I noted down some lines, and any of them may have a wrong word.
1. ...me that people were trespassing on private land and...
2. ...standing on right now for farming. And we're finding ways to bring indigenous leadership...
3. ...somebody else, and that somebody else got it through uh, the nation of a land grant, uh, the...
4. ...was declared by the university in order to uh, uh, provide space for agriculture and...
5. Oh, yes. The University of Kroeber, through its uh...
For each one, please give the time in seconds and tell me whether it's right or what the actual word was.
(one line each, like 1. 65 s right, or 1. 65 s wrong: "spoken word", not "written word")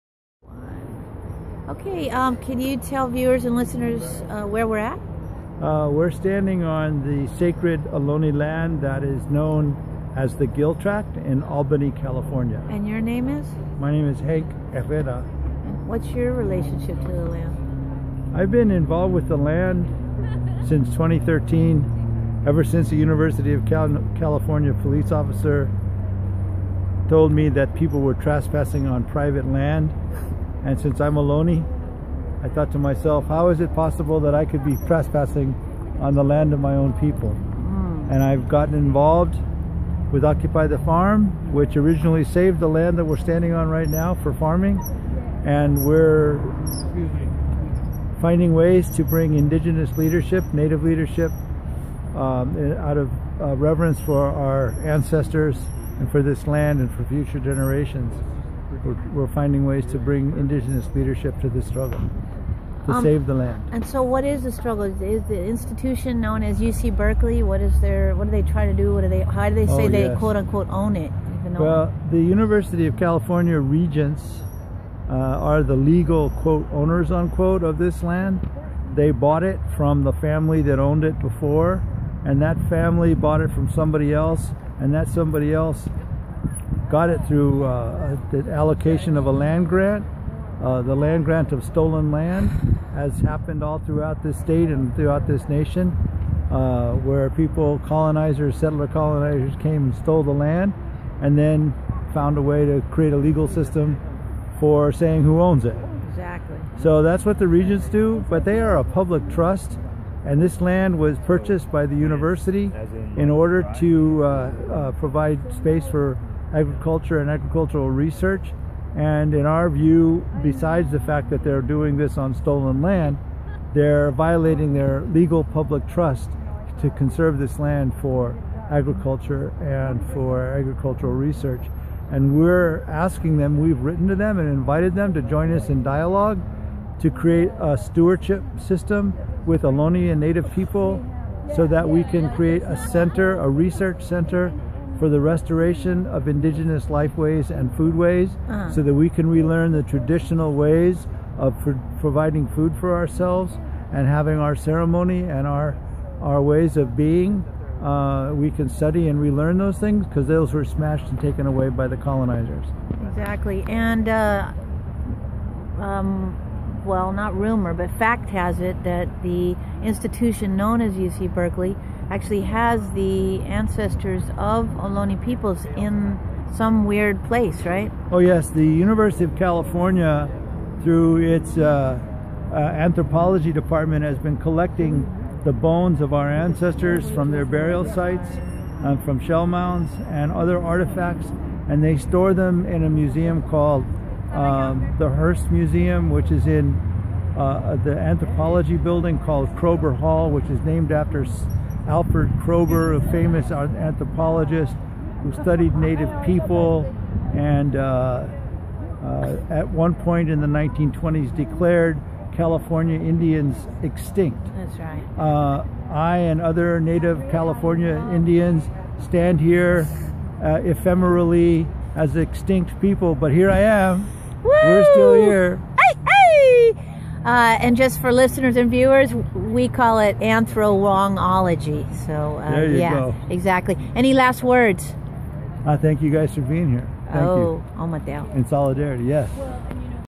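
1. 27 s right
2. 43 s right
3. 83 s wrong: "allocation", not "nation"
4. 110 s wrong: "purchased", not "declared"
5. 178 s wrong: "California", not "Kroeber".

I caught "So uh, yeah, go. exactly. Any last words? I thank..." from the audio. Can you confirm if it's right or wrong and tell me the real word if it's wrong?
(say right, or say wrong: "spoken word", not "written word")
right.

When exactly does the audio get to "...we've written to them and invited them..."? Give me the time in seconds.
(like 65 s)
133 s.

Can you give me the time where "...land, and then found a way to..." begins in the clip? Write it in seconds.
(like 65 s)
100 s.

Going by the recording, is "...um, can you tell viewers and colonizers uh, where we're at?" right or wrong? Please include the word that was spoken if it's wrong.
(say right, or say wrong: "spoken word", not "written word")
wrong: "listeners", not "colonizers".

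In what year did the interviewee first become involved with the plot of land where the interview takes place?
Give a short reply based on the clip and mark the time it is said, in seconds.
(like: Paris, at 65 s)
2013, at 20 s.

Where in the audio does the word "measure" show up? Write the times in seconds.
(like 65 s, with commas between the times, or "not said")
not said.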